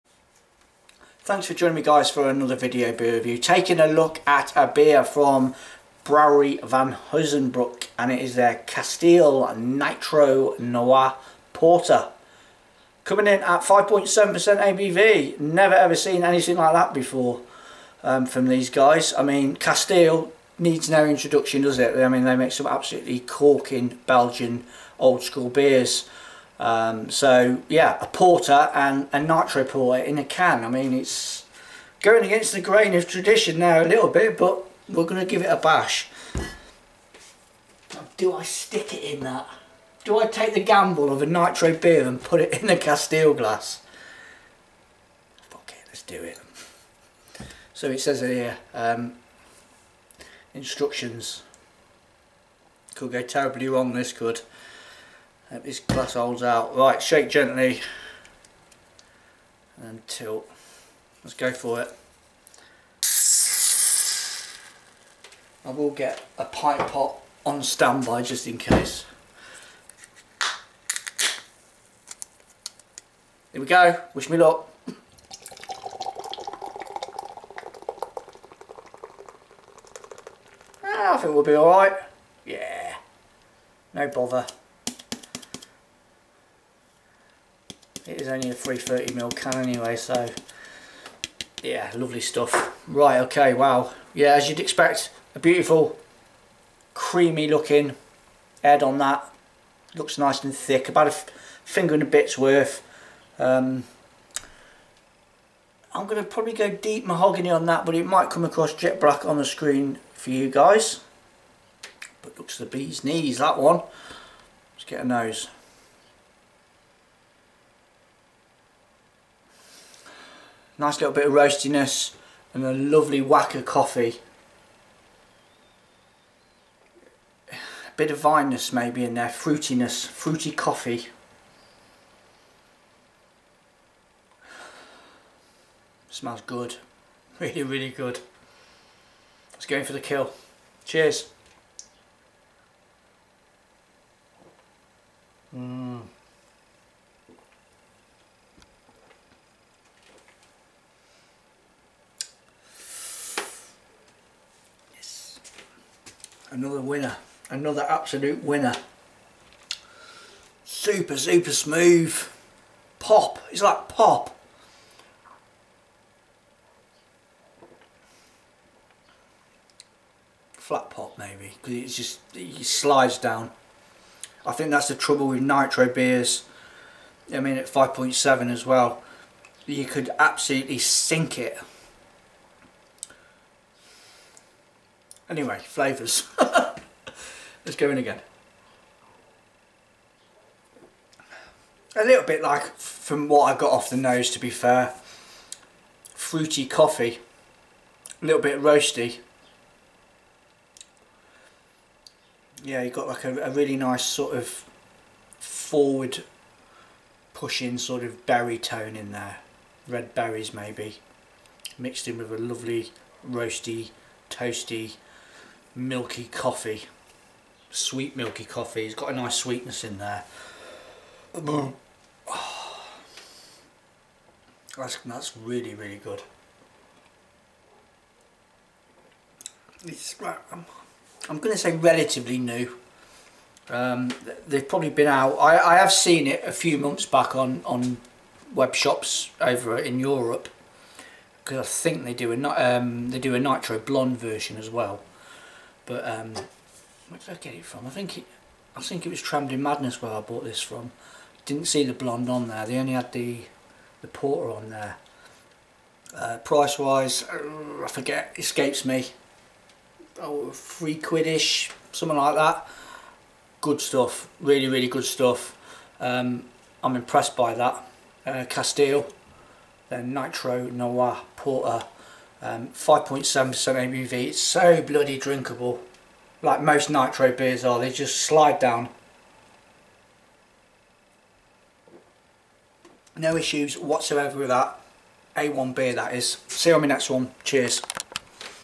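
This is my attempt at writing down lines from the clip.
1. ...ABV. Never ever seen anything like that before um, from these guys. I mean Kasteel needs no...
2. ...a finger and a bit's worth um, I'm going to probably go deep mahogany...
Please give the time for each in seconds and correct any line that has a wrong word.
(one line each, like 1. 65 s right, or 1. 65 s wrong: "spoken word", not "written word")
1. 14 s right
2. 101 s right.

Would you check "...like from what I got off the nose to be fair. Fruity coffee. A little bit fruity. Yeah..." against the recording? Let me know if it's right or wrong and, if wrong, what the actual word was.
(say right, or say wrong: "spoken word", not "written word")
wrong: "roasty", not "fruity".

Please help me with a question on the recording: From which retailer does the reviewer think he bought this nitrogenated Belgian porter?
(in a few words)
Trembling Madness.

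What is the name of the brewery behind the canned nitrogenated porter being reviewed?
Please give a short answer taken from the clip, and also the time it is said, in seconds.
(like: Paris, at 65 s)
Brewery Van Honsebrouck, at 6 s.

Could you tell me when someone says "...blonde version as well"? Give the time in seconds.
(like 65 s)
243 s.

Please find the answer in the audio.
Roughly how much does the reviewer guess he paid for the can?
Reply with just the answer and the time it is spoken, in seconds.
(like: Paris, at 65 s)
three quidish, at 260 s.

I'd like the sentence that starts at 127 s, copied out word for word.
A bit of vineness maybe in there, fruitiness, fruity coffee.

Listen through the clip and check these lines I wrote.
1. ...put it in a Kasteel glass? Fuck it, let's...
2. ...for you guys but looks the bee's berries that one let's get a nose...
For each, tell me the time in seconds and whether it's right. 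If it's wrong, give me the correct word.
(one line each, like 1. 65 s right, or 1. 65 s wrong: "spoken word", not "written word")
1. 42 s right
2. 110 s wrong: "knees", not "berries".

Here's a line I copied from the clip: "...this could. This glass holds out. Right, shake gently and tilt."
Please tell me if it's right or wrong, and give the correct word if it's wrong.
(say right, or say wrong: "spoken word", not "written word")
right.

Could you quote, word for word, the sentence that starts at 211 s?
Mixed in with a lovely roasty, toasty milky coffee.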